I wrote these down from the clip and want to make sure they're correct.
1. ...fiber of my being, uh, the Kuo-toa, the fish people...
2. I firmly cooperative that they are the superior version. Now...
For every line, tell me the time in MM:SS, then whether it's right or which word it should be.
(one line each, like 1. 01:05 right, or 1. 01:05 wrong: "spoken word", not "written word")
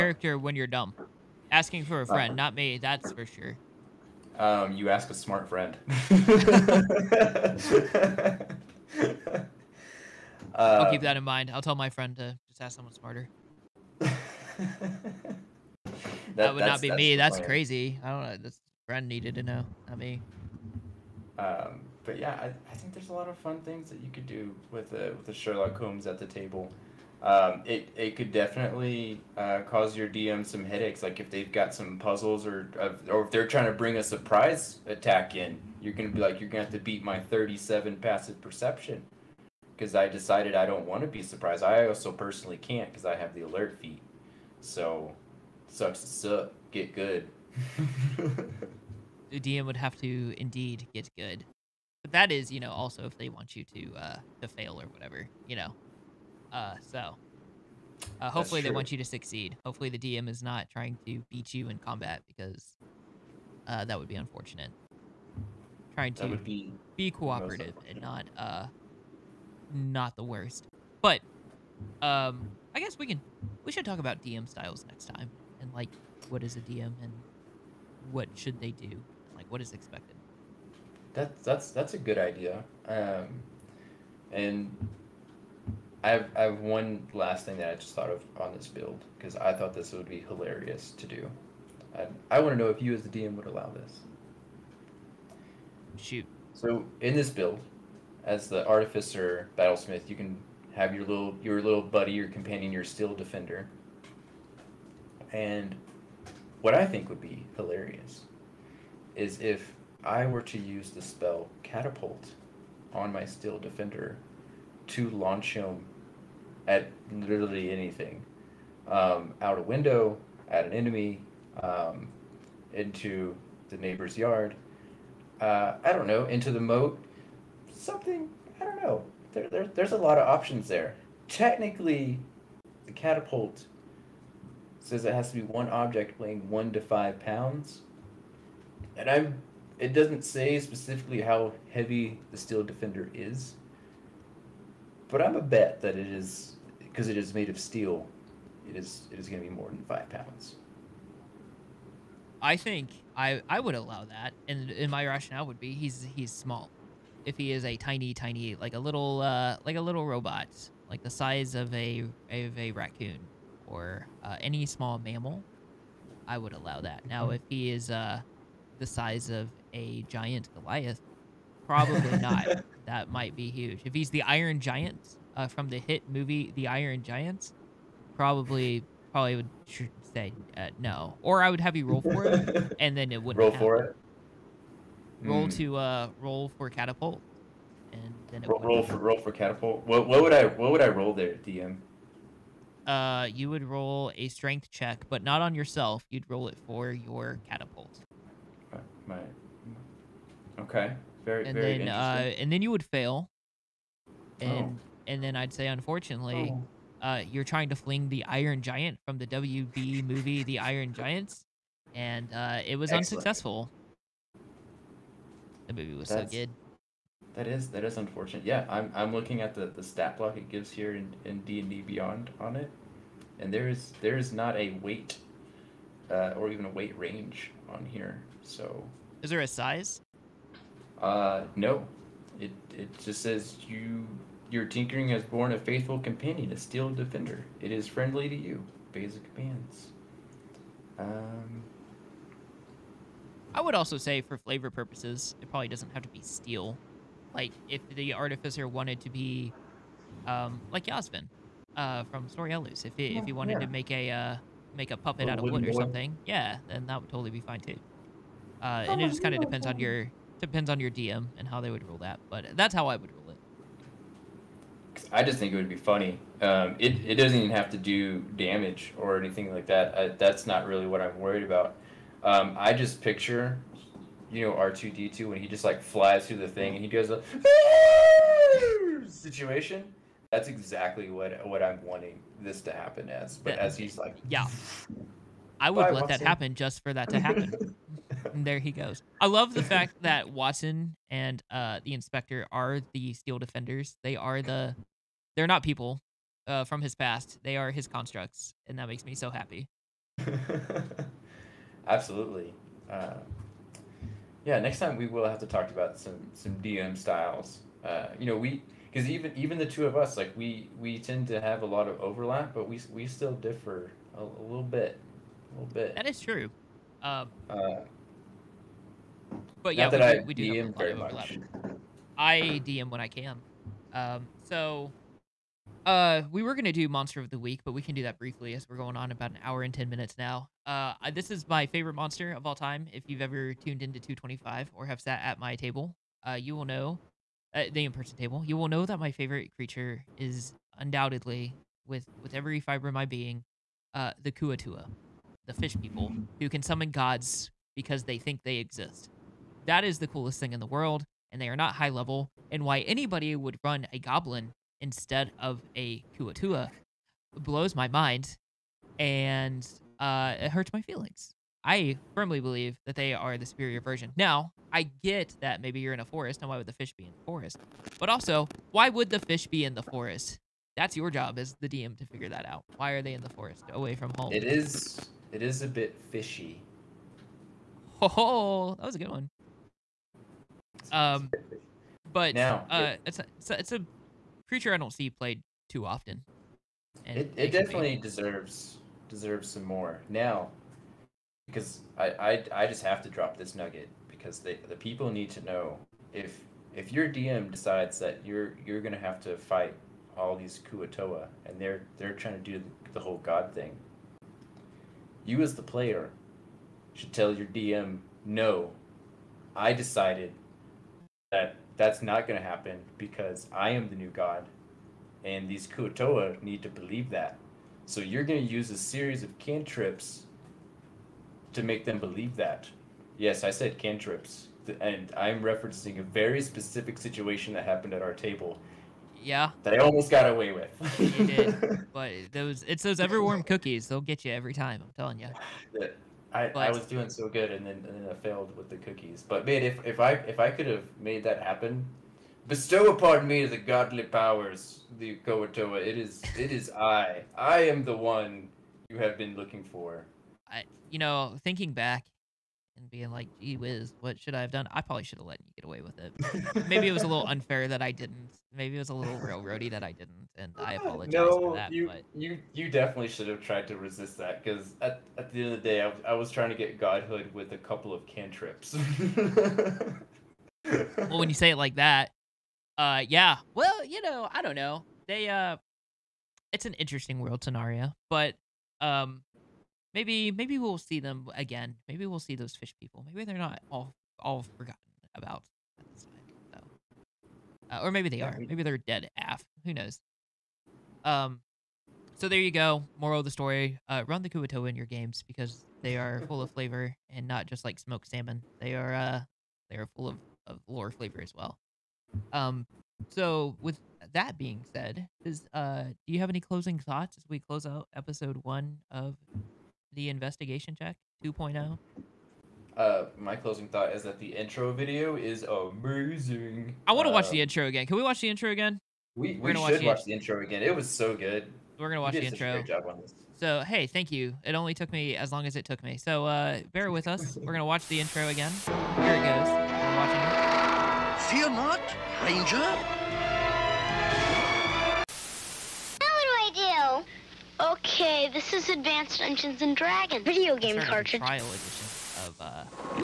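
1. 05:42 right
2. 06:01 wrong: "believe", not "cooperative".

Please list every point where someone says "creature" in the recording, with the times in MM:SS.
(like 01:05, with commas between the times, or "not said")
05:39, 06:24.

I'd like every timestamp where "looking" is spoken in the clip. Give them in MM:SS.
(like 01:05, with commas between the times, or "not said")
03:39, 07:29.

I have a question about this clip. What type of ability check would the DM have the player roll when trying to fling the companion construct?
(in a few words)
strength check.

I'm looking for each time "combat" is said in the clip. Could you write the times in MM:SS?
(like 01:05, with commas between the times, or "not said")
01:01.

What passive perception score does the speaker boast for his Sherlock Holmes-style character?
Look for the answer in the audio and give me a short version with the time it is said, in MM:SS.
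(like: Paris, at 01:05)
37, at 00:37.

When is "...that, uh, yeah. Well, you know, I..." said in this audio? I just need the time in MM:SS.
07:51.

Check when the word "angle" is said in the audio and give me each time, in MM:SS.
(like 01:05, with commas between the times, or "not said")
not said.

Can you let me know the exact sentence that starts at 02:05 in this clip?
Uh, I don't know, into the moat, something, I don't know.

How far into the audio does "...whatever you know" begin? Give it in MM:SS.
00:54.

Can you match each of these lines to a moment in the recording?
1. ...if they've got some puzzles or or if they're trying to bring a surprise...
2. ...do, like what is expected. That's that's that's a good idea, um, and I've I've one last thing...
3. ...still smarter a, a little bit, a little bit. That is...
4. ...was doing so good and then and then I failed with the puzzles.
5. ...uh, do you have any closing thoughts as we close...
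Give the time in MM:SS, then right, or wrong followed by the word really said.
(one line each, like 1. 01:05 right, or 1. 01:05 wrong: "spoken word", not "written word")
1. 00:31 right
2. 01:18 right
3. 05:13 wrong: "differ", not "smarter"
4. 07:16 wrong: "cookies", not "puzzles"
5. 08:25 right.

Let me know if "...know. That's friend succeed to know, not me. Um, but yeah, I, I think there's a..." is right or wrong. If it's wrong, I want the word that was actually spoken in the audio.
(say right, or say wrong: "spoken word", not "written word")
wrong: "needed", not "succeed".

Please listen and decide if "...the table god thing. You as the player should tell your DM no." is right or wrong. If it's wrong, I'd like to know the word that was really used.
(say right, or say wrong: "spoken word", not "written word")
wrong: "whole", not "table".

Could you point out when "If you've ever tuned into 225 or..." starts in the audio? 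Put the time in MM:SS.
05:32.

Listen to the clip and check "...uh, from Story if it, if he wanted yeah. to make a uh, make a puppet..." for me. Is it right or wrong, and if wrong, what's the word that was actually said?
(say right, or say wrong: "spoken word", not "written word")
right.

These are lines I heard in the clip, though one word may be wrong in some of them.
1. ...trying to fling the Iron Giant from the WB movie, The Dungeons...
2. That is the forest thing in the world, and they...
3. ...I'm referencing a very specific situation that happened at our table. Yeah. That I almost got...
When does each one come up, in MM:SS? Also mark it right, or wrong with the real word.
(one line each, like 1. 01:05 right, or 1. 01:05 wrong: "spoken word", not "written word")
1. 03:27 wrong: "Iron", not "Dungeons"
2. 05:49 wrong: "coolest", not "forest"
3. 07:05 right.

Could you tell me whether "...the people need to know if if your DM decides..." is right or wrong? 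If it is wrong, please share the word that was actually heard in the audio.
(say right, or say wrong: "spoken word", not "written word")
right.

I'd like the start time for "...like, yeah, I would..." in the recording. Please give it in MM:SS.
04:43.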